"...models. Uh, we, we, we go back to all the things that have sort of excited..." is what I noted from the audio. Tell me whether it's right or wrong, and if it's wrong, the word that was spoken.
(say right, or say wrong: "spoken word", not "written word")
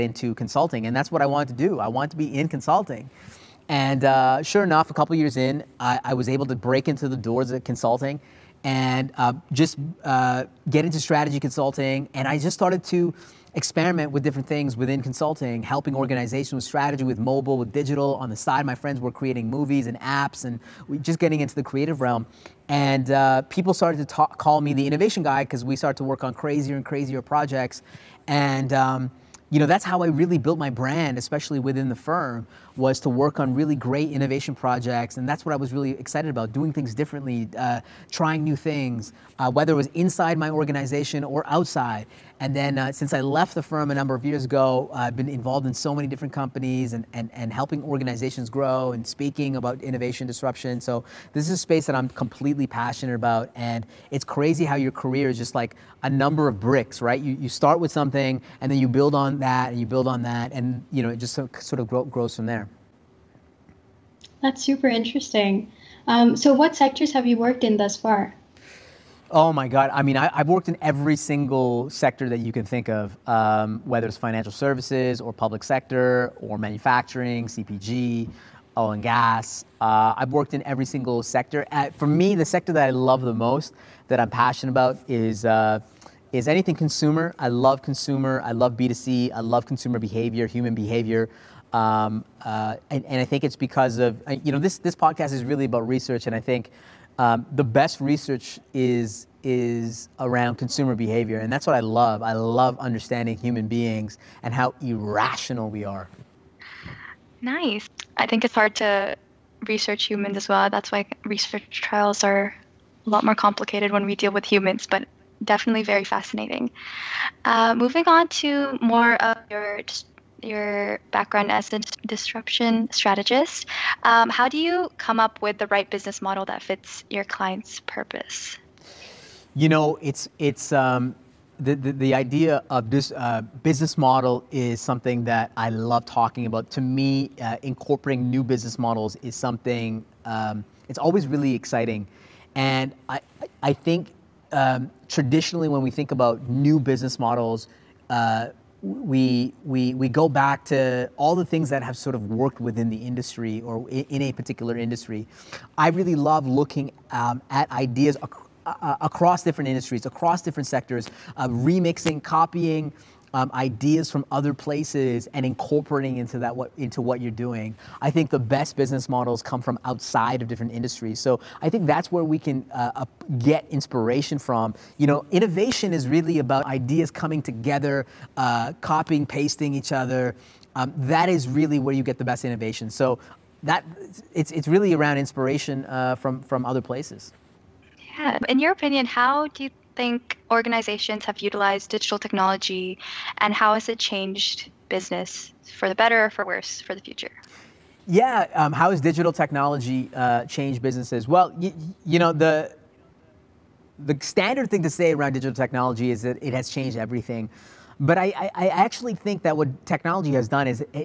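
wrong: "worked", not "excited".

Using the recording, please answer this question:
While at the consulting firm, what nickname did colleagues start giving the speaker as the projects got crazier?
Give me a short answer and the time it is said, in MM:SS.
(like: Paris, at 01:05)
the innovation guy, at 00:24.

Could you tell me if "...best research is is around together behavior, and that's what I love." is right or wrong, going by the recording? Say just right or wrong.
wrong.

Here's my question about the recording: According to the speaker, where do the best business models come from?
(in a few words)
outside of different industries.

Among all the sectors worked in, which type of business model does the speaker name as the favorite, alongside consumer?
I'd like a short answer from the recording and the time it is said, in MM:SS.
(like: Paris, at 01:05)
B2C, at 01:28.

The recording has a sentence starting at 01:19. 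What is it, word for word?
Uh, I've worked in every single sector.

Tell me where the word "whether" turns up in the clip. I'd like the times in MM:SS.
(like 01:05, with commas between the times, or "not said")
00:39, 01:13.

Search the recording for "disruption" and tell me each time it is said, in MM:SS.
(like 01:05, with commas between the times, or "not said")
00:50, 02:02.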